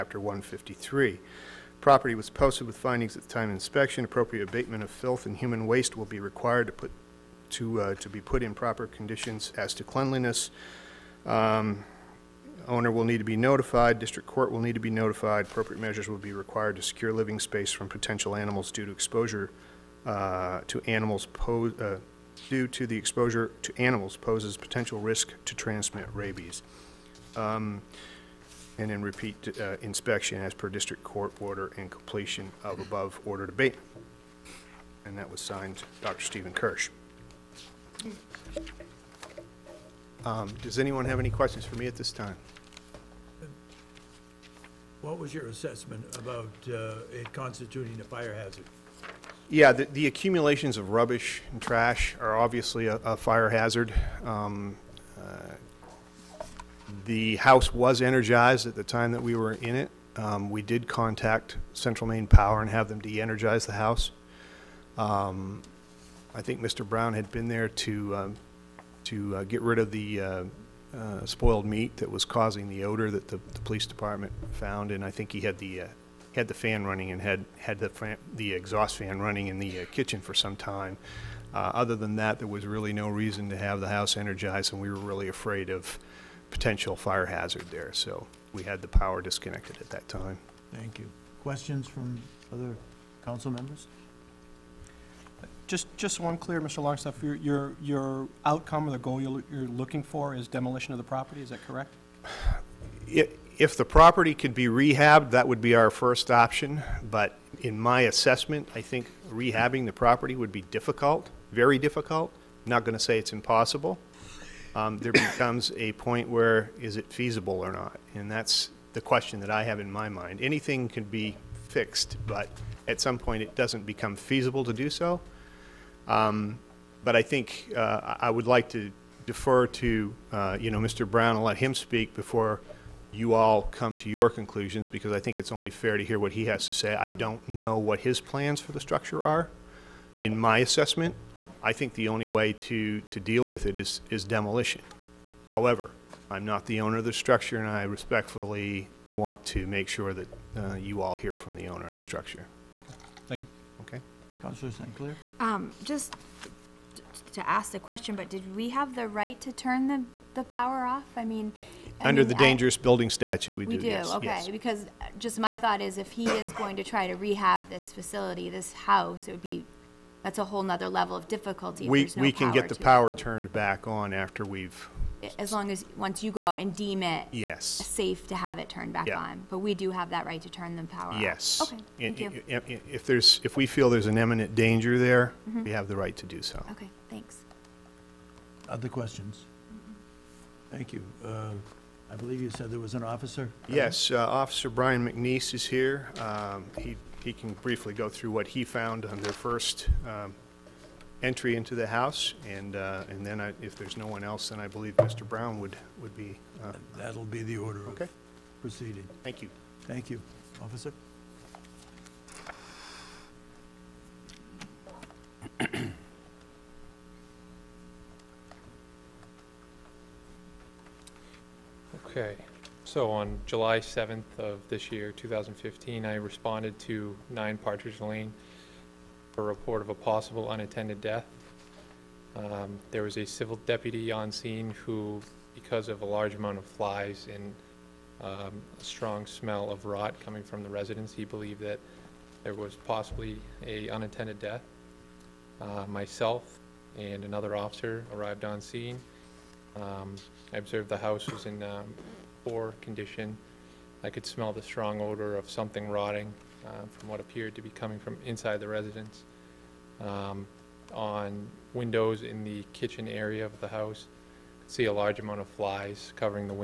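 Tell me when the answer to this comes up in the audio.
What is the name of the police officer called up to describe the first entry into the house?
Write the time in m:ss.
3:14.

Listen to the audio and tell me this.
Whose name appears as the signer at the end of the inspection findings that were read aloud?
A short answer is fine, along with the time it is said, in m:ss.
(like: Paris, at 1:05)
Dr. Stephen Kirsch, at 0:36.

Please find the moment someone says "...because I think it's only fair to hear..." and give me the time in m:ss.
2:14.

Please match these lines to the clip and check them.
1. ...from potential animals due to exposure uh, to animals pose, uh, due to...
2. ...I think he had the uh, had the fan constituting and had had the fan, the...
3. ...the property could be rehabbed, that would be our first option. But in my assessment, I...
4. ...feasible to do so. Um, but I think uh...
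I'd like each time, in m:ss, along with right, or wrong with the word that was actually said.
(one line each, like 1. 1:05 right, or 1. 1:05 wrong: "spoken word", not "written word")
1. 0:17 right
2. 1:15 wrong: "running", not "constituting"
3. 1:43 right
4. 2:04 right.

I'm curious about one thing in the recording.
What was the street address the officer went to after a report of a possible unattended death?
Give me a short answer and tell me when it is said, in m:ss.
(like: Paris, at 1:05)
9 Partridge Lane, at 3:47.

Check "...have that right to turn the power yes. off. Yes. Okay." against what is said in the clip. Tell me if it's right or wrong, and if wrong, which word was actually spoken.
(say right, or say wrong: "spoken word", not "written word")
right.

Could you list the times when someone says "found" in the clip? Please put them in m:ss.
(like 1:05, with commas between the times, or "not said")
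1:14, 3:18.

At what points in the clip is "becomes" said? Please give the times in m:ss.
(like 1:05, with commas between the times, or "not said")
1:55, 2:03.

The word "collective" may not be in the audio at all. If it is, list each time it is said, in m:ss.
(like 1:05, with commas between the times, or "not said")
not said.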